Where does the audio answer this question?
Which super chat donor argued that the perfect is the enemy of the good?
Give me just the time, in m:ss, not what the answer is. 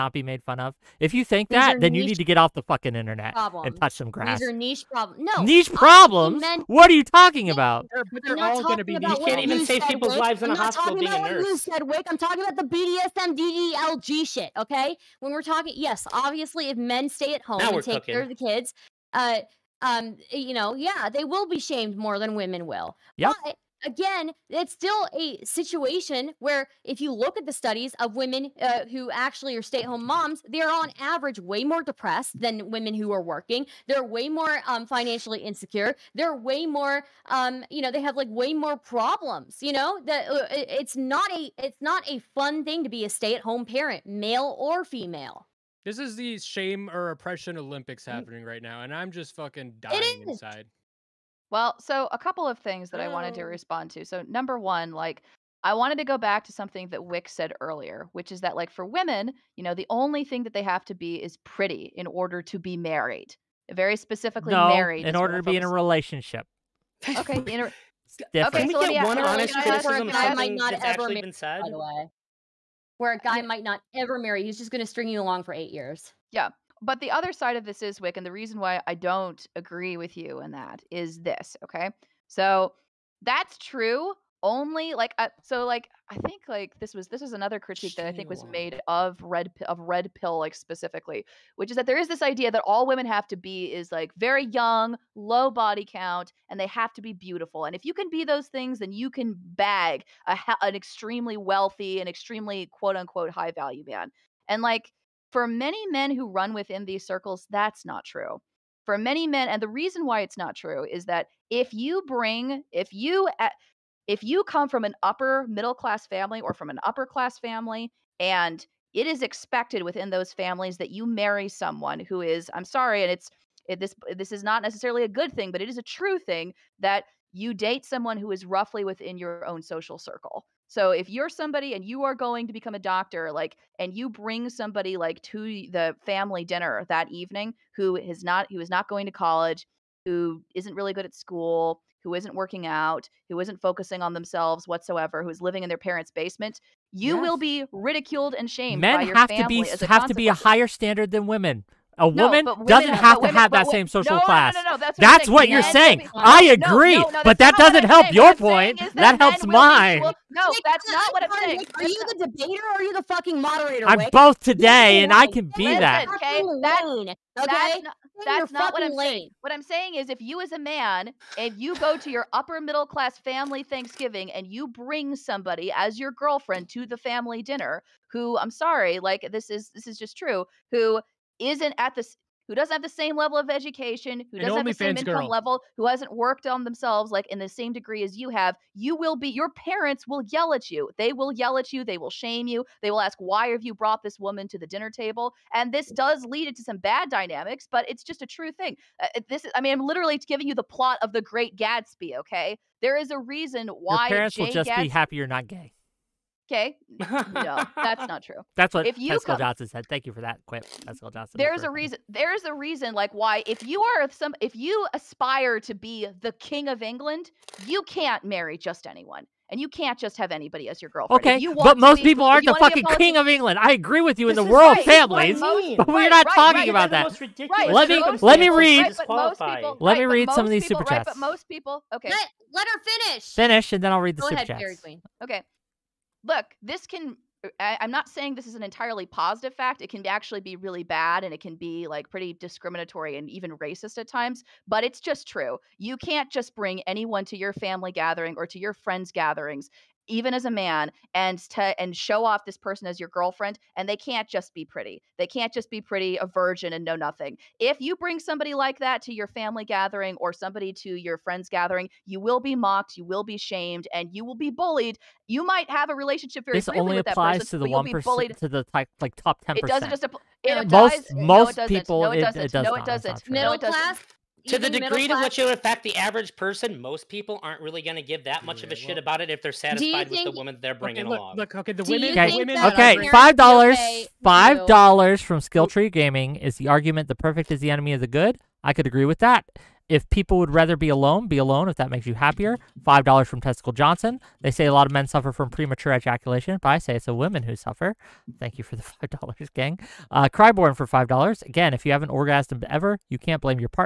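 4:45.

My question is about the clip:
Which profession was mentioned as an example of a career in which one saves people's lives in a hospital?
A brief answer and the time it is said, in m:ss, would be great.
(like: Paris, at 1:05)
Nurse, at 0:11.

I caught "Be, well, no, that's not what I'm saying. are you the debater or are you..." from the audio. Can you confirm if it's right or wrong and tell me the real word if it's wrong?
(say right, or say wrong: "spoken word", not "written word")
right.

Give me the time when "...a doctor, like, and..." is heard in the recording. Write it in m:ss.
2:12.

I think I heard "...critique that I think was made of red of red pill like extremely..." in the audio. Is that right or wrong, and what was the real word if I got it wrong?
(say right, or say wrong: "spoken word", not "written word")
wrong: "specifically", not "extremely".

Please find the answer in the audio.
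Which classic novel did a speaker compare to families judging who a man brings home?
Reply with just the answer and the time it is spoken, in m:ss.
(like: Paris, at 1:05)
The Great Gatsby, at 3:21.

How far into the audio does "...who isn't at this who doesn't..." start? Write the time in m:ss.
3:00.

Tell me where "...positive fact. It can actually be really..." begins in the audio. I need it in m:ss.
3:59.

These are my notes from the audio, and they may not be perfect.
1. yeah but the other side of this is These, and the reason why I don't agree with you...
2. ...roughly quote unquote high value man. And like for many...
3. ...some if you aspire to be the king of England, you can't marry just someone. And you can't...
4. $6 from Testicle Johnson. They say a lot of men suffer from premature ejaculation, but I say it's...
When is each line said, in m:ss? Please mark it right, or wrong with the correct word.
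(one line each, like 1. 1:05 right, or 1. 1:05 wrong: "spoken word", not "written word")
1. 1:16 wrong: "Whick", not "These"
2. 1:42 wrong: "extremely", not "roughly"
3. 3:34 wrong: "anyone", not "someone"
4. 4:52 wrong: "5", not "6".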